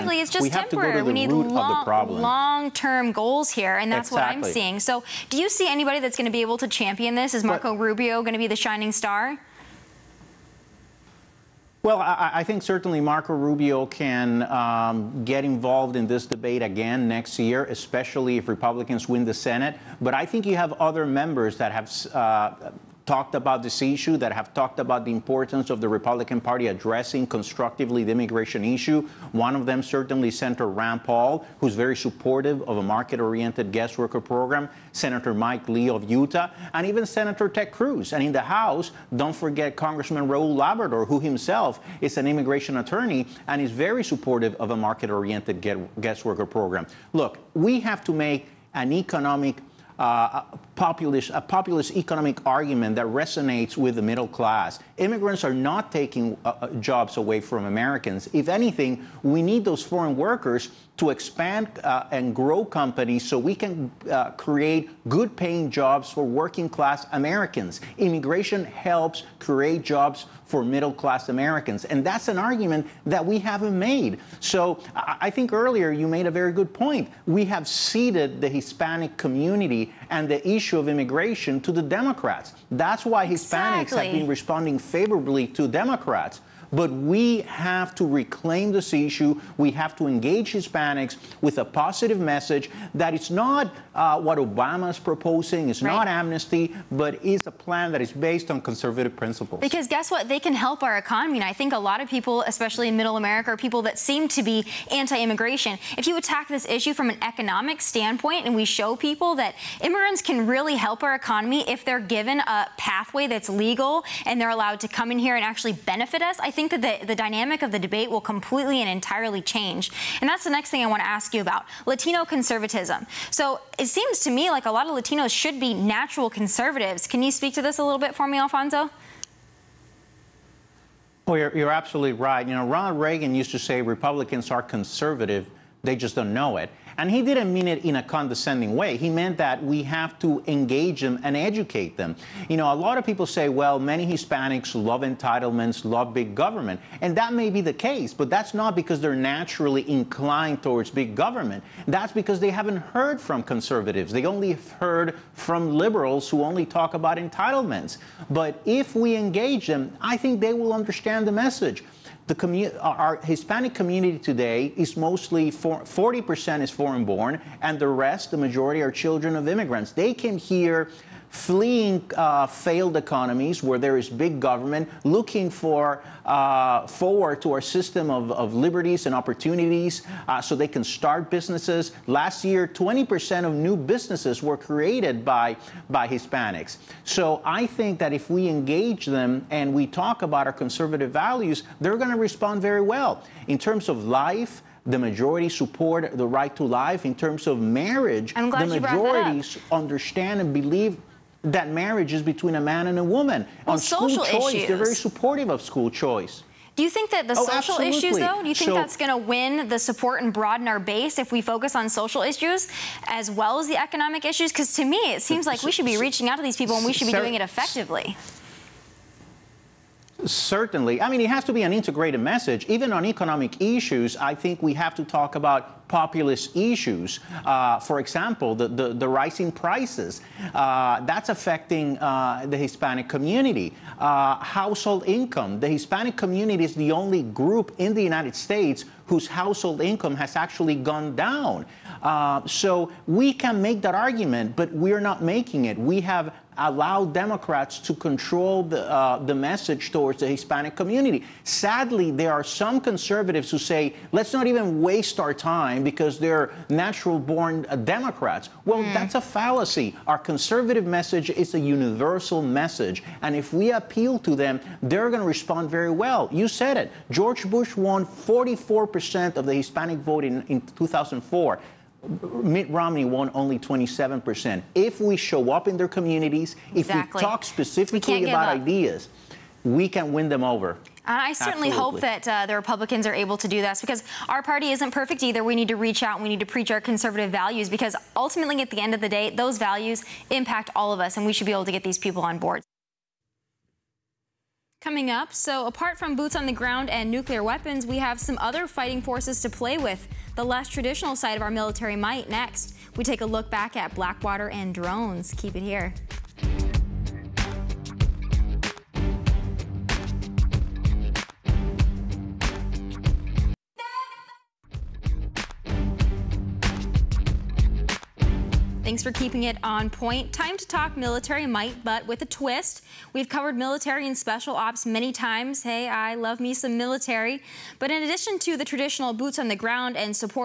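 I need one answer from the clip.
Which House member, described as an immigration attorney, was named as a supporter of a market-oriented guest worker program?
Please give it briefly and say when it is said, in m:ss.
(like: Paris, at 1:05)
Raul Labrador, at 0:40.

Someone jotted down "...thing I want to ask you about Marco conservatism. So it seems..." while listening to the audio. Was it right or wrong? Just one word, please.
wrong.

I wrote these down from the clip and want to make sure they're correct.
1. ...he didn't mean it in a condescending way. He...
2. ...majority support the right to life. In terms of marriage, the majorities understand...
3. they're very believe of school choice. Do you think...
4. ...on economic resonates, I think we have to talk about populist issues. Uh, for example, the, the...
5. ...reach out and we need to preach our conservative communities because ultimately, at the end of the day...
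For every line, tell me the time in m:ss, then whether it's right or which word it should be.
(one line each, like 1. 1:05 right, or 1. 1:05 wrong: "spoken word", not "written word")
1. 2:17 right
2. 3:14 right
3. 3:24 wrong: "supportive", not "believe"
4. 3:42 wrong: "issues", not "resonates"
5. 4:45 wrong: "values", not "communities".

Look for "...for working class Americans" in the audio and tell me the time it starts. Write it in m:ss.
1:06.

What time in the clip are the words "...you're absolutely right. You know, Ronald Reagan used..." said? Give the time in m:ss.
2:11.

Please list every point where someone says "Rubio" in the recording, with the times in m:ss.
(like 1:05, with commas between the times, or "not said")
0:07, 0:13.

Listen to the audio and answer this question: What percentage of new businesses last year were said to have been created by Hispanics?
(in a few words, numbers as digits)
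20%.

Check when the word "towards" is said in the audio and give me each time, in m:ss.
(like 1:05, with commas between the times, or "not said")
2:30, 4:09.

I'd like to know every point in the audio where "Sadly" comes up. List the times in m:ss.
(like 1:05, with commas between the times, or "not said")
4:11.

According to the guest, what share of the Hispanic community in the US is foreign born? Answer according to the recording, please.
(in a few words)
40%.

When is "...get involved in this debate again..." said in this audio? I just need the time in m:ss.
0:15.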